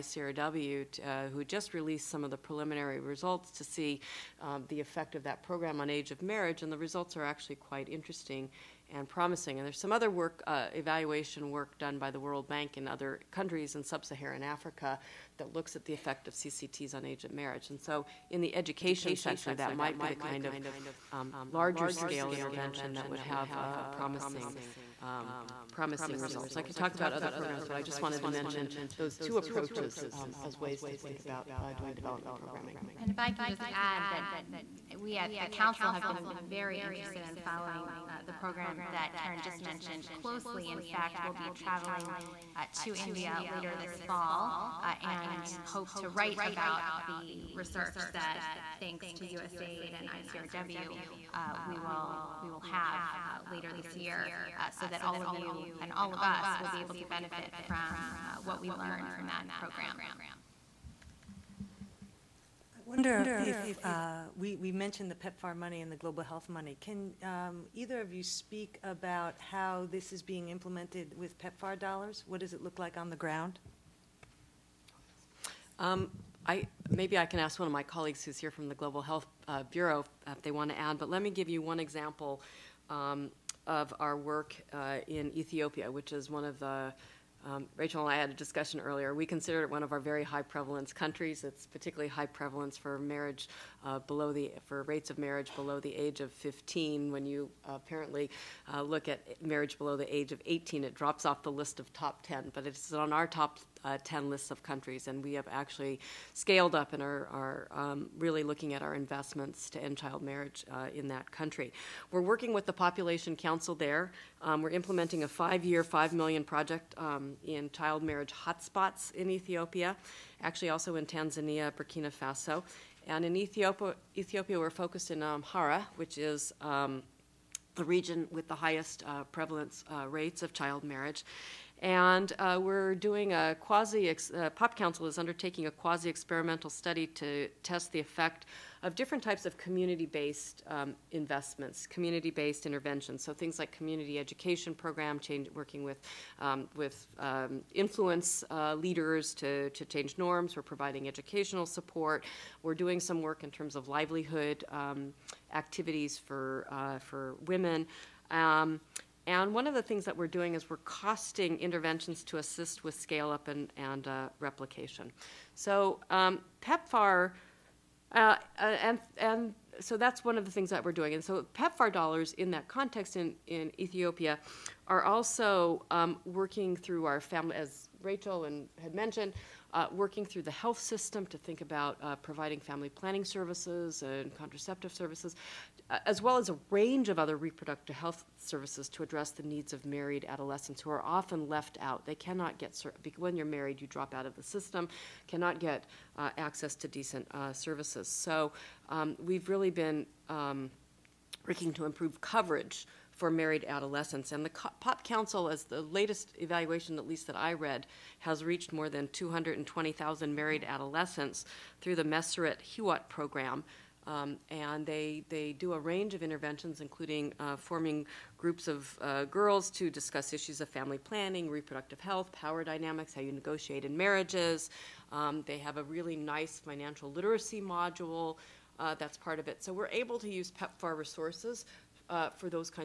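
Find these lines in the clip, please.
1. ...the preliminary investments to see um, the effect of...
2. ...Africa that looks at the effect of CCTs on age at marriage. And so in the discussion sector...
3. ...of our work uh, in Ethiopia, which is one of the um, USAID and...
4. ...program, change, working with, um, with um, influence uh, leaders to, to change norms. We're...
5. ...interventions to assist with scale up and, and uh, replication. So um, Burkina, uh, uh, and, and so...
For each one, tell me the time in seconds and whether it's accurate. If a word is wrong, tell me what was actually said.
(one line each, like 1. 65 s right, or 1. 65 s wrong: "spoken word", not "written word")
1. 2 s wrong: "results", not "investments"
2. 14 s wrong: "education", not "discussion"
3. 83 s wrong: "Rachel", not "USAID"
4. 144 s right
5. 161 s wrong: "PEPFAR", not "Burkina".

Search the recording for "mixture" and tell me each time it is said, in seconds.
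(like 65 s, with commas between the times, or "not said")
not said.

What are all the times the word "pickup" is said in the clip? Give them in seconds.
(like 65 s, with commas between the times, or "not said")
not said.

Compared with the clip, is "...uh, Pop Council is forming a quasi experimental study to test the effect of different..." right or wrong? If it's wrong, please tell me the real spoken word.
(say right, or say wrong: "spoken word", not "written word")
wrong: "undertaking", not "forming".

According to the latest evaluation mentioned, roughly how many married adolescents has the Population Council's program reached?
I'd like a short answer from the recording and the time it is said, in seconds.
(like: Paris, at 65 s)
220,000, at 209 s.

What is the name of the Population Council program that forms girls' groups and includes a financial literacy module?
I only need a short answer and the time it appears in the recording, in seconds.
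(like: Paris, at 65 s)
Meseret Hiwot, at 212 s.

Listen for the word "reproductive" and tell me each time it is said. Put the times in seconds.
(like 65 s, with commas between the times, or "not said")
187 s, 221 s.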